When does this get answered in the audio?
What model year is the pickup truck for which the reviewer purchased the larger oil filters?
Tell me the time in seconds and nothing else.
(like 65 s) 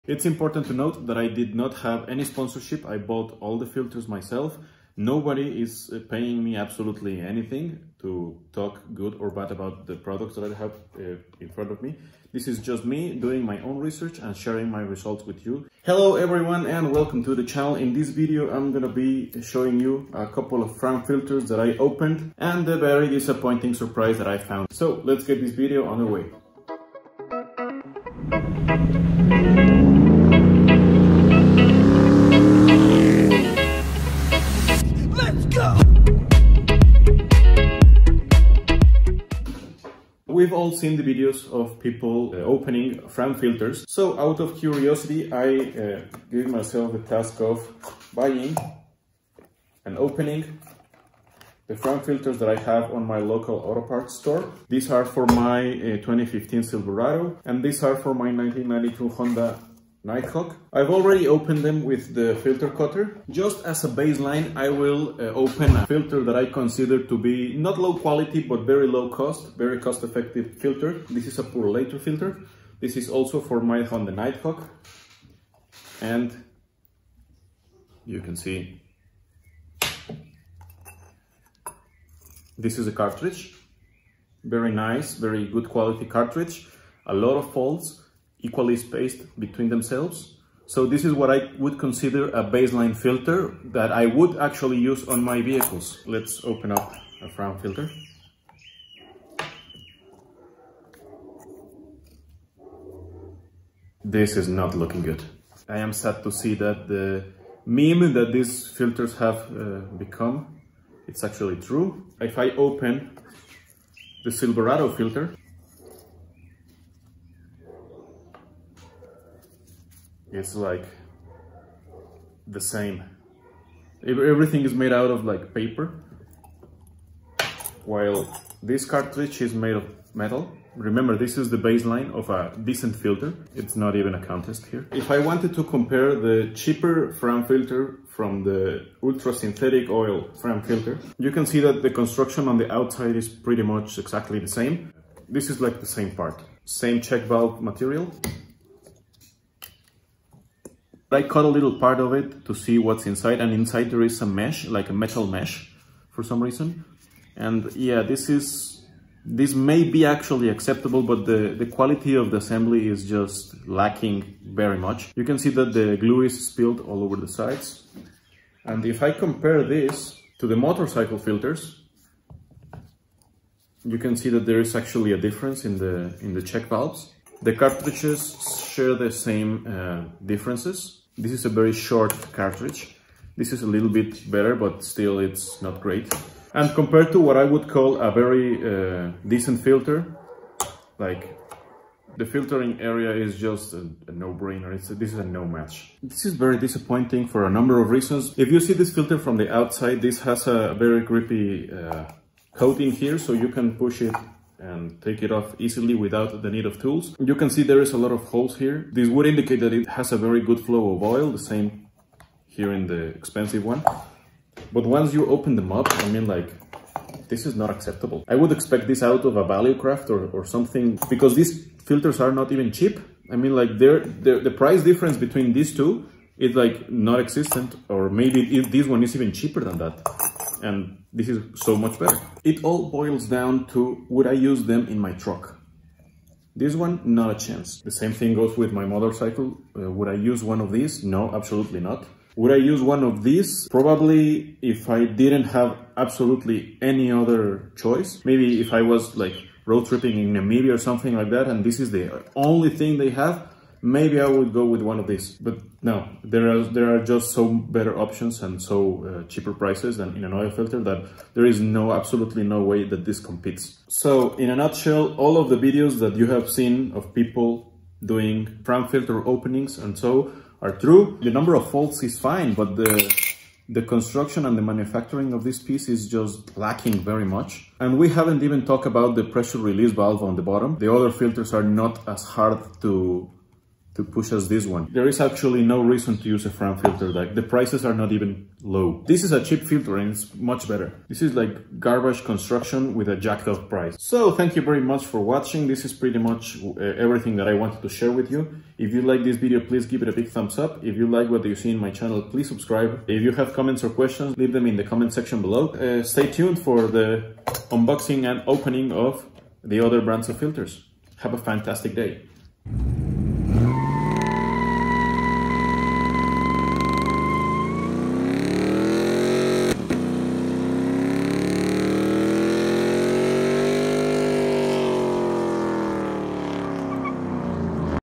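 56 s.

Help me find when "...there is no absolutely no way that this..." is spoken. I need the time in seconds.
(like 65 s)
261 s.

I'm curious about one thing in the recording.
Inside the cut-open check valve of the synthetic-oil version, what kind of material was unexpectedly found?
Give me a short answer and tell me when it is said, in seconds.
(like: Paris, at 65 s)
metal mesh, at 154 s.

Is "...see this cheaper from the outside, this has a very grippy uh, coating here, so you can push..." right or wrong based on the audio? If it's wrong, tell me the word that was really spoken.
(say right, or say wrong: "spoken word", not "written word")
wrong: "filter", not "cheaper".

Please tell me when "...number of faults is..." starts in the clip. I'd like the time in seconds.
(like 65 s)
271 s.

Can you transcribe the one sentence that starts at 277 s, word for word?
And we haven't even talked about the pressure release valve on the bottom.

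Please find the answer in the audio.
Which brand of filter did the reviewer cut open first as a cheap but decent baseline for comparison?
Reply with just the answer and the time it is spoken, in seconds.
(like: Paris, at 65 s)
Purolator, at 71 s.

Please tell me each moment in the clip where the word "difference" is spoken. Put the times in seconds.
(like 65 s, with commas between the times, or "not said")
175 s, 180 s, 224 s.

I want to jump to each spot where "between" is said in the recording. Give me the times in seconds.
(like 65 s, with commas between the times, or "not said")
89 s, 225 s.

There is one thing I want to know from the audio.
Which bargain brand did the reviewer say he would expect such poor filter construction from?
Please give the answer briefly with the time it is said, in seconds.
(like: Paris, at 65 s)
Valucraft, at 219 s.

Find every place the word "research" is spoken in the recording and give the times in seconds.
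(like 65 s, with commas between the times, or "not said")
13 s.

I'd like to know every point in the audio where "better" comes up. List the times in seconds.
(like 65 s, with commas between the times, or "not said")
184 s, 231 s, 257 s, 290 s.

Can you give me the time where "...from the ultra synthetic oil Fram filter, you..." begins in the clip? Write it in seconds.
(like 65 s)
138 s.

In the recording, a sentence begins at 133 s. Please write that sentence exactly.
It's not even a contest here.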